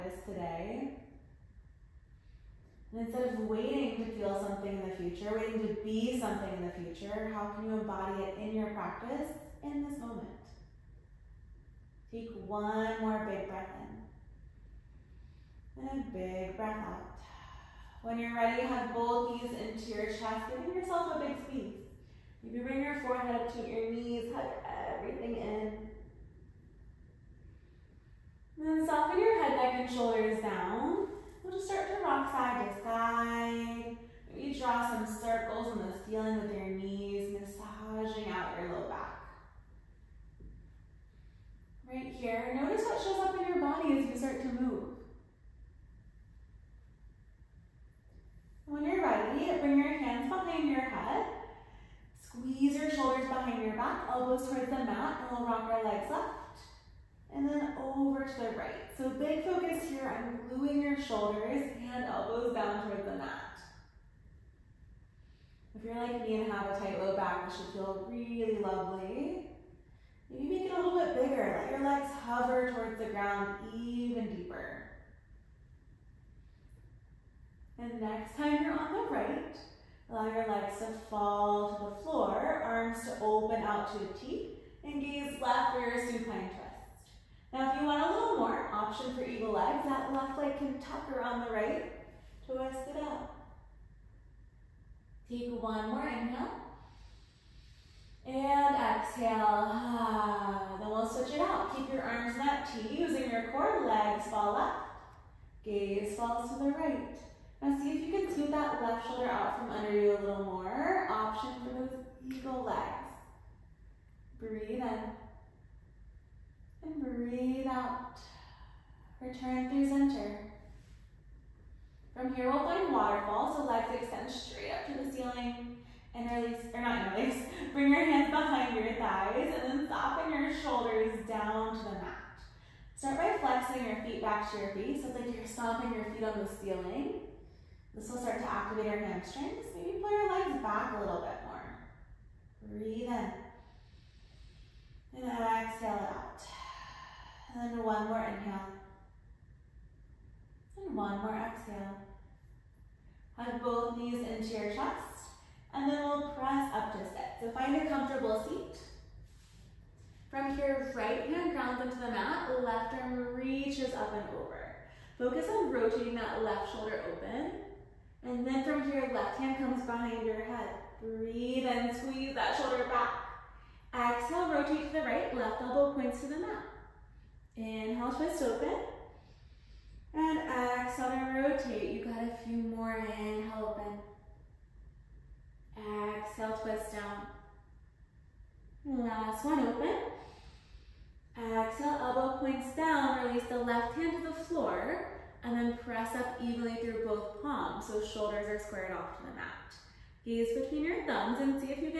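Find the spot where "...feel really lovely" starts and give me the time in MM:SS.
01:07.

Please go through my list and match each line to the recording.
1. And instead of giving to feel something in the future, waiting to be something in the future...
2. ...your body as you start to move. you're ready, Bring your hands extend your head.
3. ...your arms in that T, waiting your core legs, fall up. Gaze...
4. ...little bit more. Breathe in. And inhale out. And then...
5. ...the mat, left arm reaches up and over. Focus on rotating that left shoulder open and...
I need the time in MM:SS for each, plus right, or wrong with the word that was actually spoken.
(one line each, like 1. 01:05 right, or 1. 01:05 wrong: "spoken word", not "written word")
1. 00:02 wrong: "waiting", not "giving"
2. 00:43 wrong: "behind", not "extend"
3. 01:41 wrong: "using", not "waiting"
4. 02:20 wrong: "exhale", not "inhale"
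5. 02:41 right.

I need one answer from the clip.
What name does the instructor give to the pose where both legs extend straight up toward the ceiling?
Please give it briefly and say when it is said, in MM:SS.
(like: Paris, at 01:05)
Waterfall, at 02:02.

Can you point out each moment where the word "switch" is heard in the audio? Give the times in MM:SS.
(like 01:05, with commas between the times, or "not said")
01:41.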